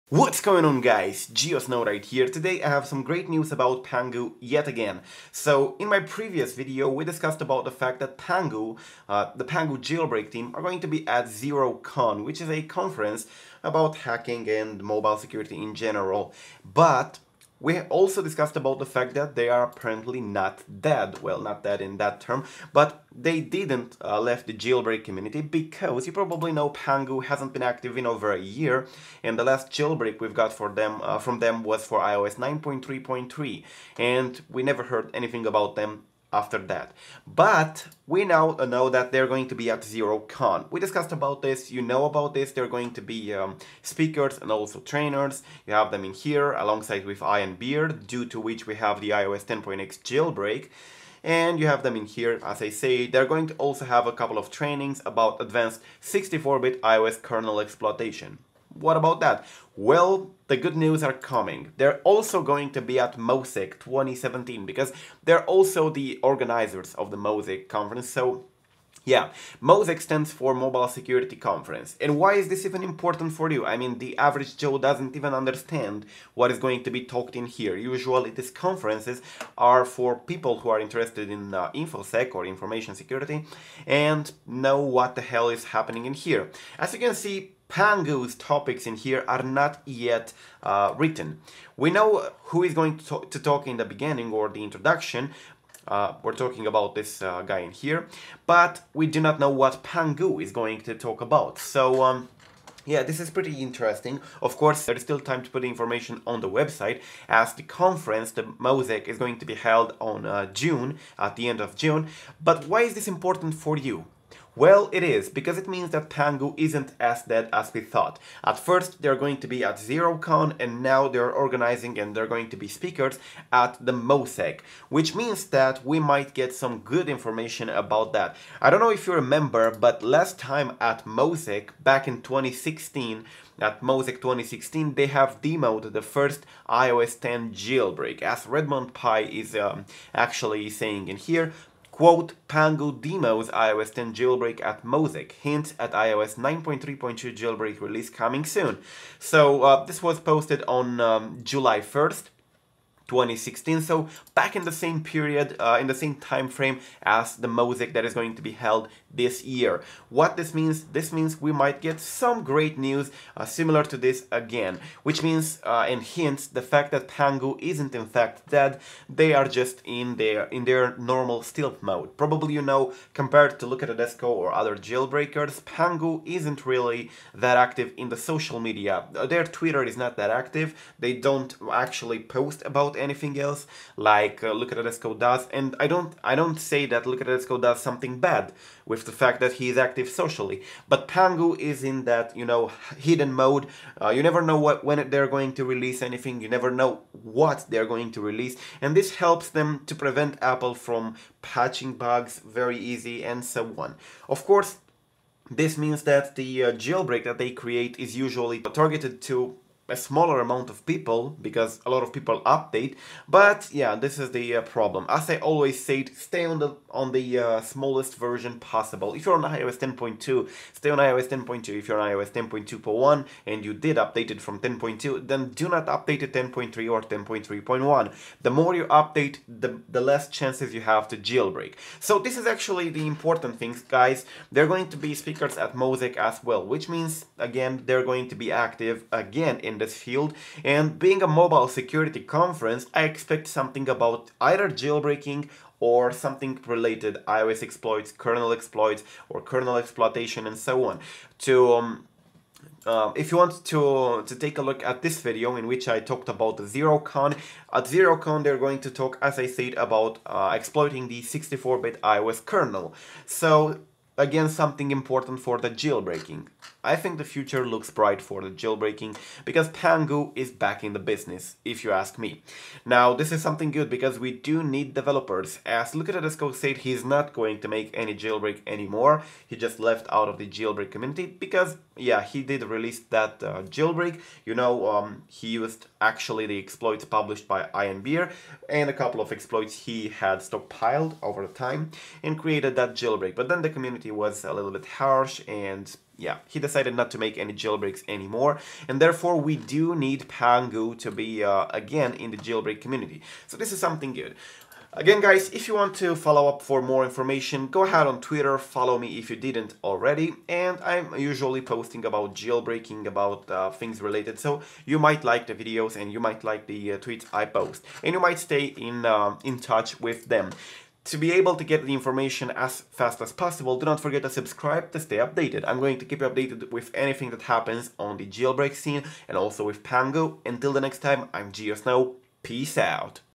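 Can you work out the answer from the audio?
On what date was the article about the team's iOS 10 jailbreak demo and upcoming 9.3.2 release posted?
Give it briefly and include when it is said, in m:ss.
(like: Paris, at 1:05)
July 1st, 2016, at 2:31.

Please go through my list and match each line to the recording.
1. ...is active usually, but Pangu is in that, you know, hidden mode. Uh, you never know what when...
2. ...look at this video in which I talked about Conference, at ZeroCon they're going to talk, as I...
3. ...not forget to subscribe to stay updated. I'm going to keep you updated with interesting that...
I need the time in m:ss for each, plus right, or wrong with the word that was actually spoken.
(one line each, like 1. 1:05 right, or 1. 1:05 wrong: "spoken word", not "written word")
1. 3:09 wrong: "socially", not "usually"
2. 4:14 wrong: "ZeroCon", not "Conference"
3. 5:23 wrong: "anything", not "interesting".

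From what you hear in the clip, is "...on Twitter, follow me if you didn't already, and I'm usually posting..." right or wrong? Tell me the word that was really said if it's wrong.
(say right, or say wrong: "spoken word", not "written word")
right.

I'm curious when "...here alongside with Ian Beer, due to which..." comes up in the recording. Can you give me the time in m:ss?
0:46.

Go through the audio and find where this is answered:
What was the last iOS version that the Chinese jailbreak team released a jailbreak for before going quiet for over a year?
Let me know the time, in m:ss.
0:31.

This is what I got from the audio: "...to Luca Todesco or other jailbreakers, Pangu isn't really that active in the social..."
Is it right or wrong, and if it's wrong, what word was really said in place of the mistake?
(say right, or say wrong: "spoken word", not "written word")
right.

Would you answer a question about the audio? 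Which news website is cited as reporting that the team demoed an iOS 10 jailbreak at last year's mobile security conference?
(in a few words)
Redmond Pie.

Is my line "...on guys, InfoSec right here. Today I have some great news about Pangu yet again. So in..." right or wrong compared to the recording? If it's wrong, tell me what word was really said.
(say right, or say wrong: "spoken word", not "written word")
wrong: "Geosnow", not "InfoSec".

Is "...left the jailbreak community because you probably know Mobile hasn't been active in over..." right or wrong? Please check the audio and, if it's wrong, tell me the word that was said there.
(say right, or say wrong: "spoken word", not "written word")
wrong: "Pangu", not "Mobile".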